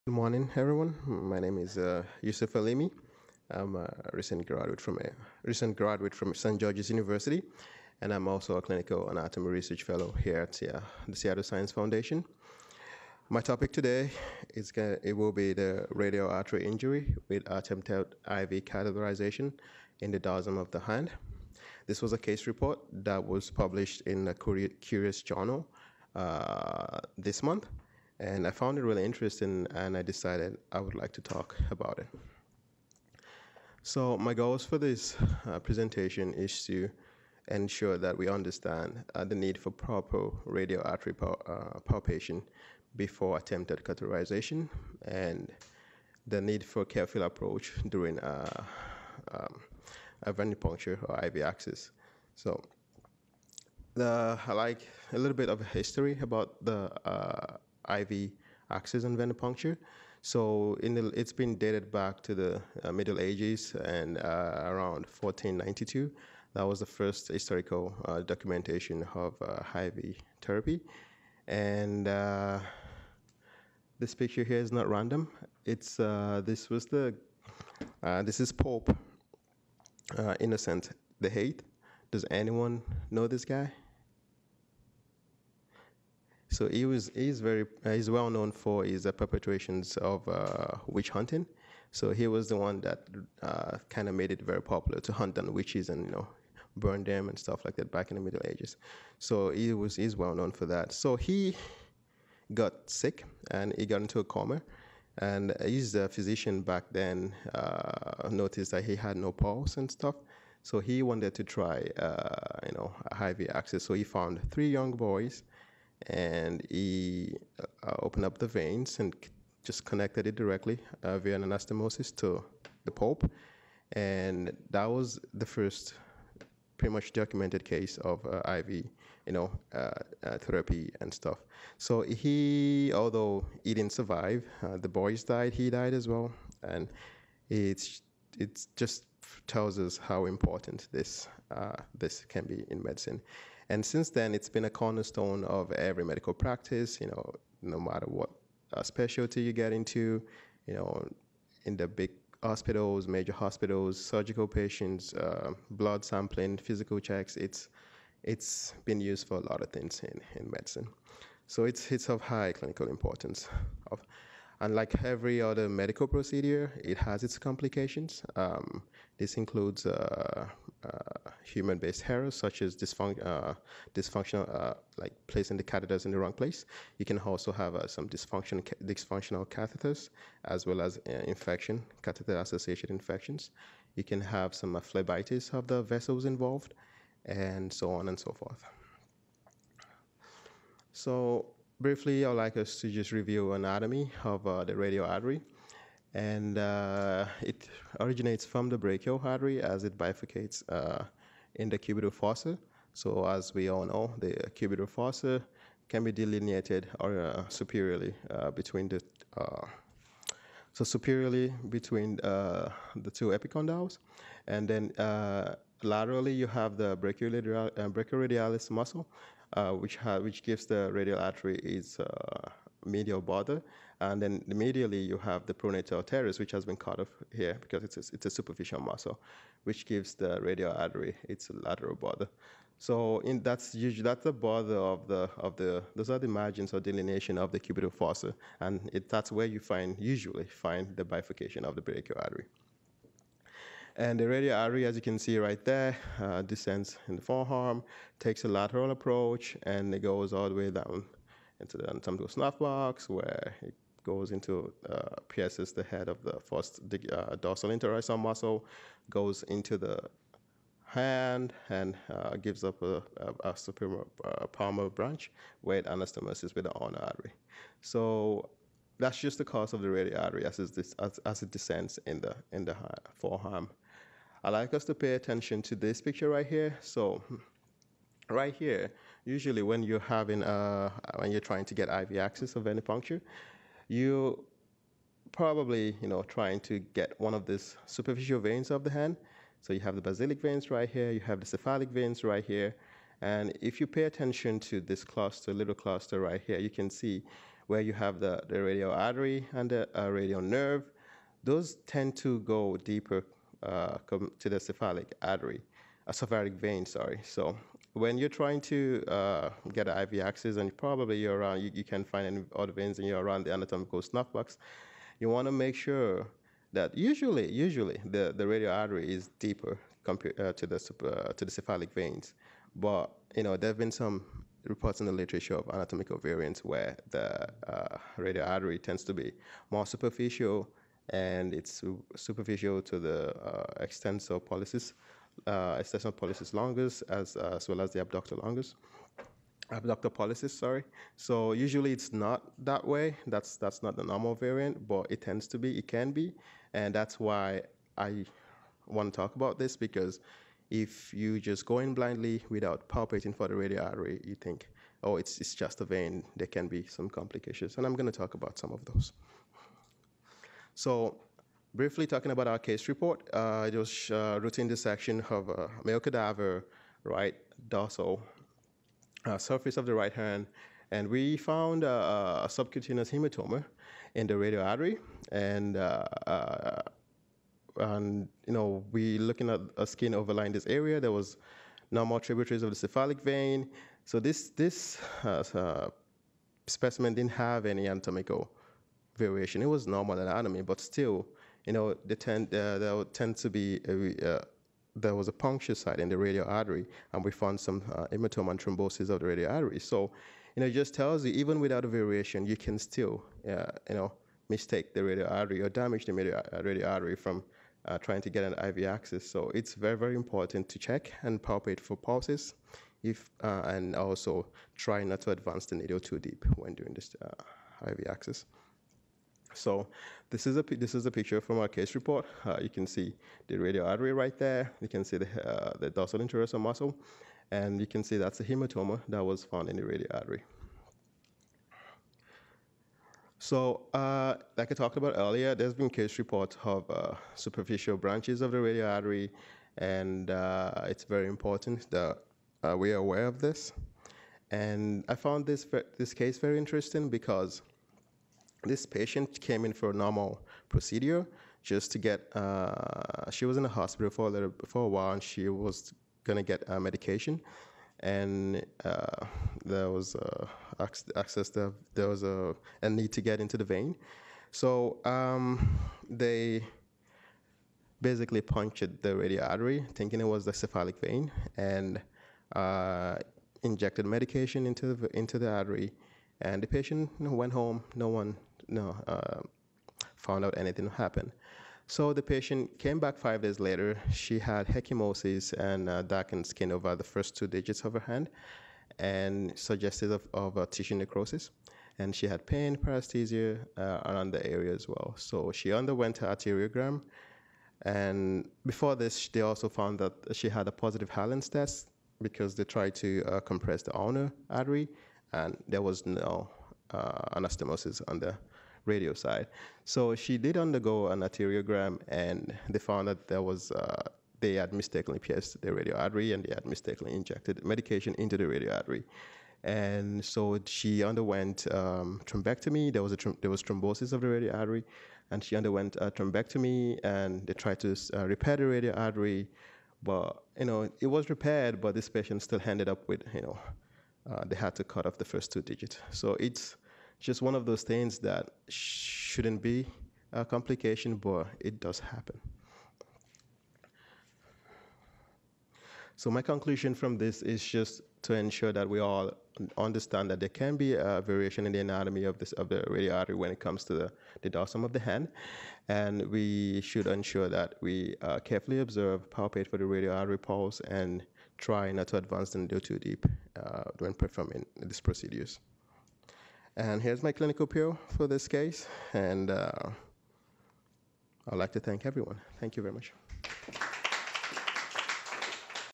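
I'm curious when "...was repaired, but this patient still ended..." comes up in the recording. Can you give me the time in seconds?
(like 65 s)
531 s.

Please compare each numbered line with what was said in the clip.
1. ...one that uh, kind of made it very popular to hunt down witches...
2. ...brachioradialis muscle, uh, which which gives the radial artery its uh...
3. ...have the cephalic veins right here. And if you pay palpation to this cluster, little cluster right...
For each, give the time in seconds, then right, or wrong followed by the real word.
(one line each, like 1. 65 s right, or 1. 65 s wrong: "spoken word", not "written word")
1. 92 s right
2. 217 s right
3. 291 s wrong: "attention", not "palpation".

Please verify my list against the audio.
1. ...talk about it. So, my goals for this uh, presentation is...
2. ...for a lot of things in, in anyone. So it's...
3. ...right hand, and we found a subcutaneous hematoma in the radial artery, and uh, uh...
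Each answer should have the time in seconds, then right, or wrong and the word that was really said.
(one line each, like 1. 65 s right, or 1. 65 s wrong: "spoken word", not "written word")
1. 31 s right
2. 159 s wrong: "medicine", not "anyone"
3. 369 s right.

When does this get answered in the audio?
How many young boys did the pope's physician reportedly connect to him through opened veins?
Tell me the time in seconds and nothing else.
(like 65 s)
114 s.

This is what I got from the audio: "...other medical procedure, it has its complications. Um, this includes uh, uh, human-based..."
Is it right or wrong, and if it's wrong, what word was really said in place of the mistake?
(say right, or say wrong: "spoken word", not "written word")
right.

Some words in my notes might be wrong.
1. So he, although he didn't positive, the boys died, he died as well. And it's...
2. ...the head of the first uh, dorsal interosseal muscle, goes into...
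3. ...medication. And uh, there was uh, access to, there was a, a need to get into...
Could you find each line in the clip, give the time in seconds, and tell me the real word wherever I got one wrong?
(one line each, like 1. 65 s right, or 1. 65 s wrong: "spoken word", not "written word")
1. 131 s wrong: "survive", not "positive"
2. 255 s right
3. 456 s right.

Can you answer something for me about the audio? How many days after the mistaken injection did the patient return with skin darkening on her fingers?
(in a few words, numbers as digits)
5.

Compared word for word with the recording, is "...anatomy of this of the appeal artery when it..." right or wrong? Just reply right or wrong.
wrong.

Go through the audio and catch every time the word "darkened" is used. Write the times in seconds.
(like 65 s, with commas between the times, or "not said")
486 s.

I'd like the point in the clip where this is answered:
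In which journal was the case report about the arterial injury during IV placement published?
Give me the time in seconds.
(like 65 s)
24 s.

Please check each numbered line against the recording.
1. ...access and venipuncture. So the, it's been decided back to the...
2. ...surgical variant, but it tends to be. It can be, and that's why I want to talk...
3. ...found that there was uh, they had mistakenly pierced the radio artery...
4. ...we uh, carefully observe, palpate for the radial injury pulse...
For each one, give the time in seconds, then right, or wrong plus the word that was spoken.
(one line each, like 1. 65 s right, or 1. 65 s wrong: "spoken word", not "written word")
1. 58 s wrong: "dated", not "decided"
2. 344 s wrong: "normal", not "surgical"
3. 512 s right
4. 557 s wrong: "artery", not "injury".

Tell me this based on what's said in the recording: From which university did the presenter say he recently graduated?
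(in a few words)
St. George's University.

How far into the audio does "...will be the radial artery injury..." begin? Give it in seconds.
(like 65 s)
15 s.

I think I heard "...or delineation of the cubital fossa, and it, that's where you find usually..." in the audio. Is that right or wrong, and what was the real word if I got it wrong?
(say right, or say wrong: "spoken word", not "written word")
right.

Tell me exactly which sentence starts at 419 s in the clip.
So this is a this is a picture from our case report.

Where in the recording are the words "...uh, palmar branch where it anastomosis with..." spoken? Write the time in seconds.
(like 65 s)
264 s.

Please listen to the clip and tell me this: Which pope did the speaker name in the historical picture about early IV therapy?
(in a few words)
Pope Innocent the Eighth.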